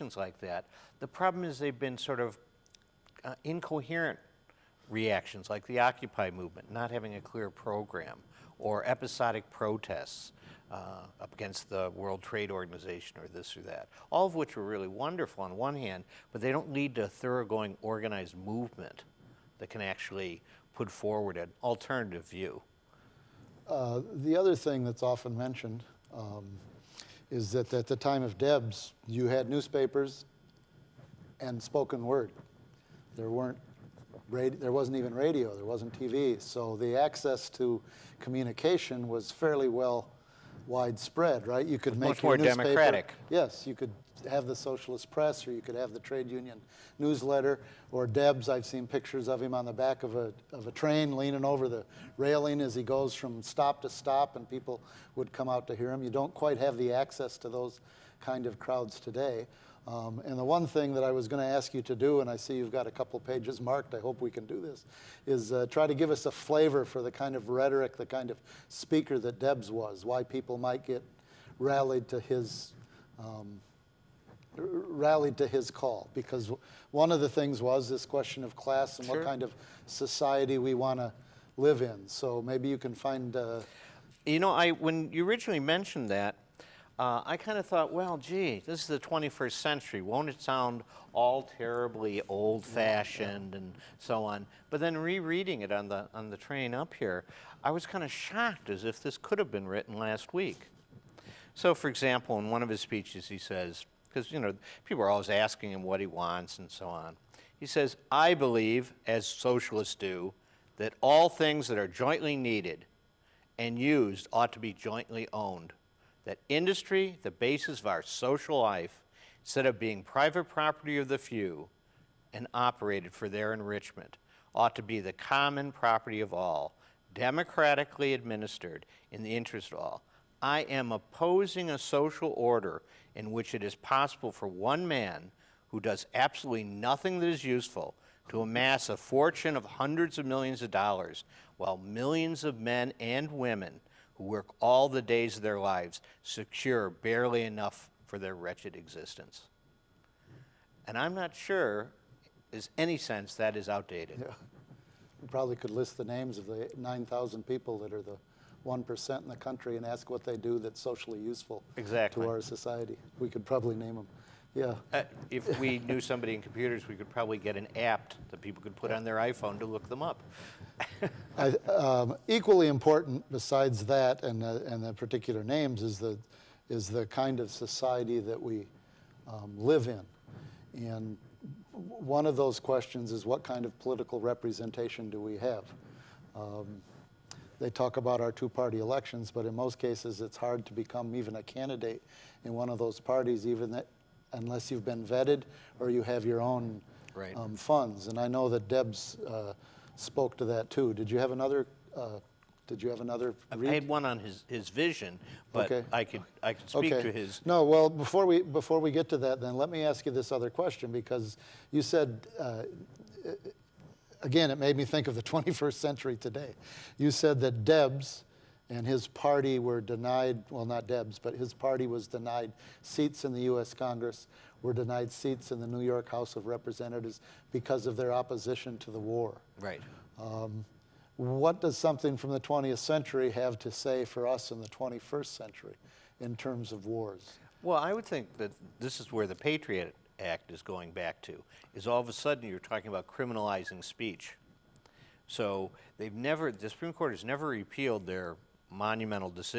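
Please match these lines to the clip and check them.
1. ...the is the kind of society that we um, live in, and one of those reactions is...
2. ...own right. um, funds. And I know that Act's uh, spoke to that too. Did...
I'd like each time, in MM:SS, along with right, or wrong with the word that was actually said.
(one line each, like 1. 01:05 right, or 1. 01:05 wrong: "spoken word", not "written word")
1. 02:55 wrong: "questions", not "reactions"
2. 03:16 wrong: "Deb", not "Act".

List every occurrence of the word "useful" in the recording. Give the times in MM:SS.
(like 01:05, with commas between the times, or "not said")
02:17, 02:41.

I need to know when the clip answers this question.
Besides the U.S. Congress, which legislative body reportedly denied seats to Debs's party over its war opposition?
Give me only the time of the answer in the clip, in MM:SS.
03:45.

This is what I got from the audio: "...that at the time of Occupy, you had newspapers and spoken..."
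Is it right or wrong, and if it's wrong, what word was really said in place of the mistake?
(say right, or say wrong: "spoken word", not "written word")
wrong: "Debs", not "Occupy".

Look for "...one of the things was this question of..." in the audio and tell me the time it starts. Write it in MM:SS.
01:16.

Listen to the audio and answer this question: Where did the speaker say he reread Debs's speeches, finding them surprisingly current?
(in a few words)
On the train.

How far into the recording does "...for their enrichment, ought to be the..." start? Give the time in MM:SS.
02:03.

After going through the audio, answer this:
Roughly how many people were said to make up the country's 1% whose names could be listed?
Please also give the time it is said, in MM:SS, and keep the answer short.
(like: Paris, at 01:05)
9,000, at 02:36.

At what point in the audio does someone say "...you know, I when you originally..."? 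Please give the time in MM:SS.
01:24.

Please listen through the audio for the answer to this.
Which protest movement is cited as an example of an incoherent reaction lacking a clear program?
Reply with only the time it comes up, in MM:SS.
00:05.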